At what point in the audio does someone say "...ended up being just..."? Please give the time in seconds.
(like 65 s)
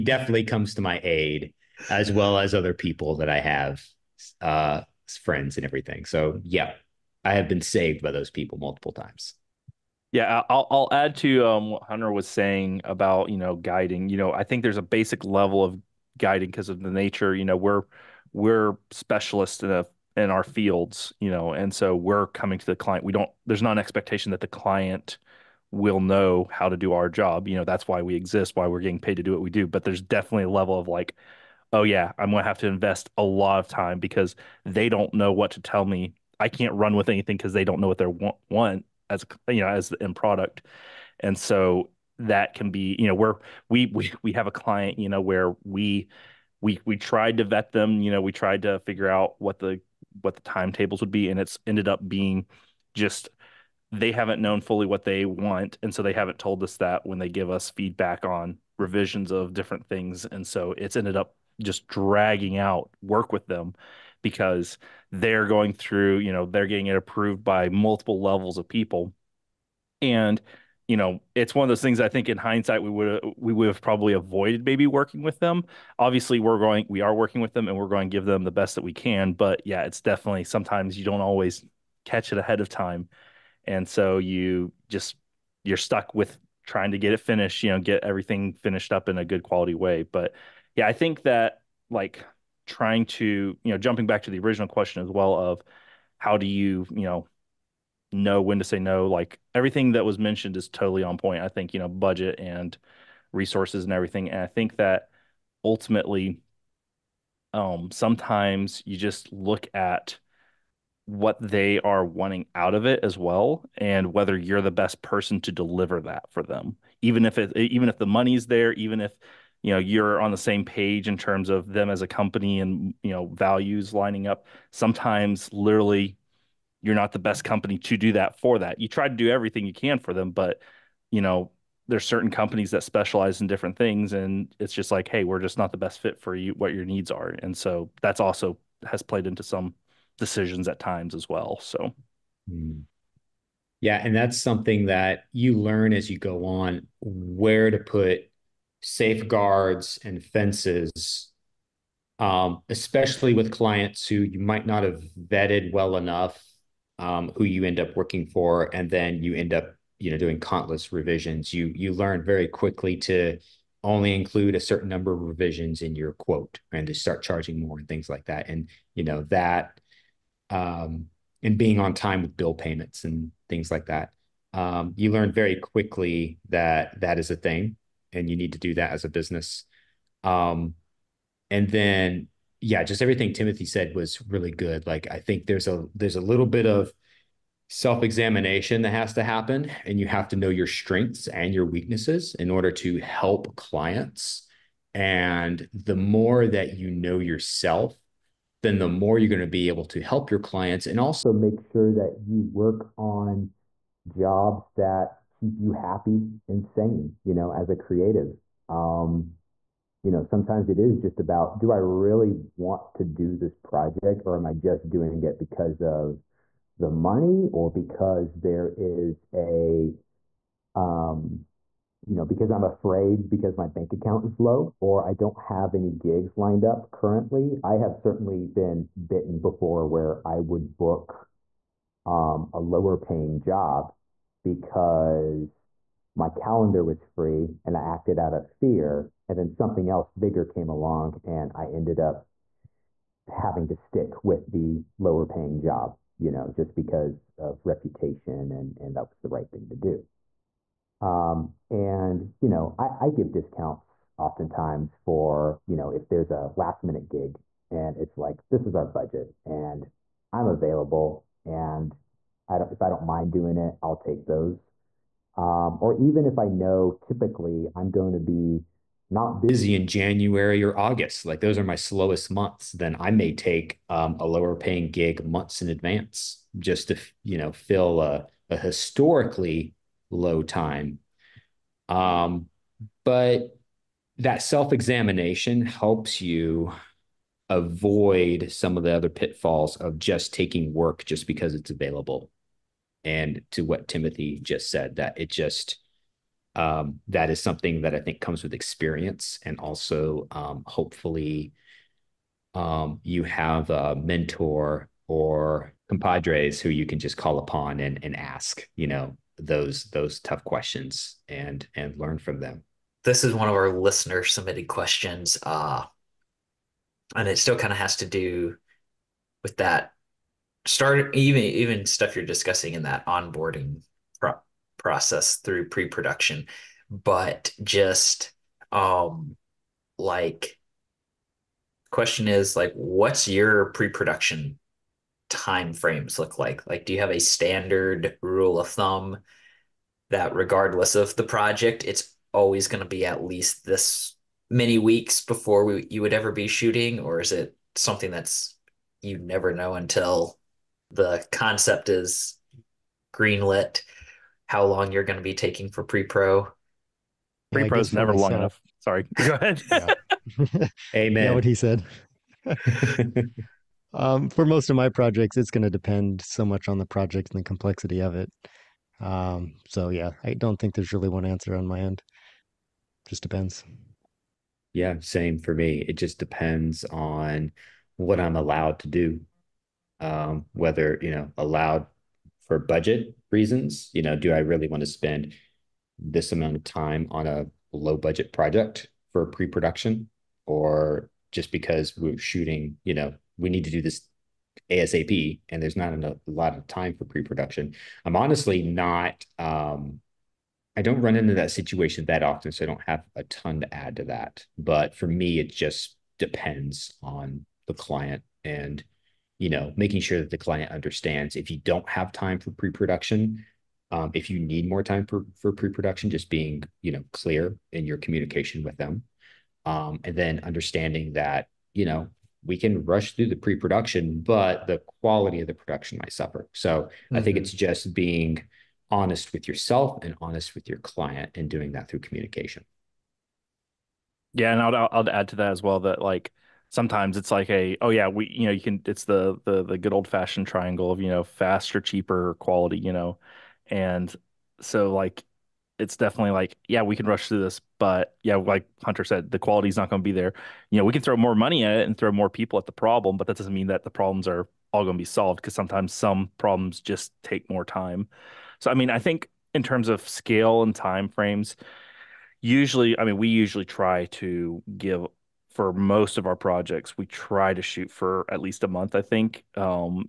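51 s.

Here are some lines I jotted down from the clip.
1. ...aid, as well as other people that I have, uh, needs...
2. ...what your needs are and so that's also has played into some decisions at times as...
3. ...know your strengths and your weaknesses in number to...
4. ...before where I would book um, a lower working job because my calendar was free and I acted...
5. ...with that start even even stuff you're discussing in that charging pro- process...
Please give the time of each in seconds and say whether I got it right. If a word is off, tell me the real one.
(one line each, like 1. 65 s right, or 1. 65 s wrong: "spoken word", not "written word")
1. 1 s wrong: "friends", not "needs"
2. 136 s right
3. 190 s wrong: "order", not "number"
4. 229 s wrong: "paying", not "working"
5. 319 s wrong: "onboarding", not "charging".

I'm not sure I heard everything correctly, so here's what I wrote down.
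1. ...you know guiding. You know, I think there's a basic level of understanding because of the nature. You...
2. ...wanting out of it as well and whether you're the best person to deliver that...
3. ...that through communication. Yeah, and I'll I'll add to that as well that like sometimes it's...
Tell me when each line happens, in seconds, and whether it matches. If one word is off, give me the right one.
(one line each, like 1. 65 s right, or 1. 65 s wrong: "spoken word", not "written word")
1. 13 s wrong: "guiding", not "understanding"
2. 112 s right
3. 431 s right.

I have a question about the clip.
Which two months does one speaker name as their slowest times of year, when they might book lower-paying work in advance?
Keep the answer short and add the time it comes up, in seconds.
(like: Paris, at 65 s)
January or August, at 269 s.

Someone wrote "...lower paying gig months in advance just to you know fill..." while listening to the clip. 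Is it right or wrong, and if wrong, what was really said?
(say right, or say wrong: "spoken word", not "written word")
right.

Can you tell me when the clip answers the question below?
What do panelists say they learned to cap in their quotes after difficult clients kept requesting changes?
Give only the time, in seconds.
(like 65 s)
164 s.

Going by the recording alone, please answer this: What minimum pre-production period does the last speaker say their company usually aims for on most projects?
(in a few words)
a month.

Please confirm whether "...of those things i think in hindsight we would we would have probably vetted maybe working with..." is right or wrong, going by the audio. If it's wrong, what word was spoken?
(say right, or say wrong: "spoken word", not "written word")
wrong: "avoided", not "vetted".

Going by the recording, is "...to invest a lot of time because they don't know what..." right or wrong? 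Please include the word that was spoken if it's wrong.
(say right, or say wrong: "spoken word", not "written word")
right.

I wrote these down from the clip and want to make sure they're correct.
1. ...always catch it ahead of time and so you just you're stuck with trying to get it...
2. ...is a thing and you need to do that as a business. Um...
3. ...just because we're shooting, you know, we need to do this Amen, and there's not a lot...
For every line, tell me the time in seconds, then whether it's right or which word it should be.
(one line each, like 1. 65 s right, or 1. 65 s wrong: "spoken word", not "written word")
1. 81 s right
2. 177 s right
3. 391 s wrong: "ASAP", not "Amen".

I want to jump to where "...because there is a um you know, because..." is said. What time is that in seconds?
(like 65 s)
217 s.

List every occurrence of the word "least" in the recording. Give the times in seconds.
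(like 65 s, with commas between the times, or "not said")
343 s, 468 s.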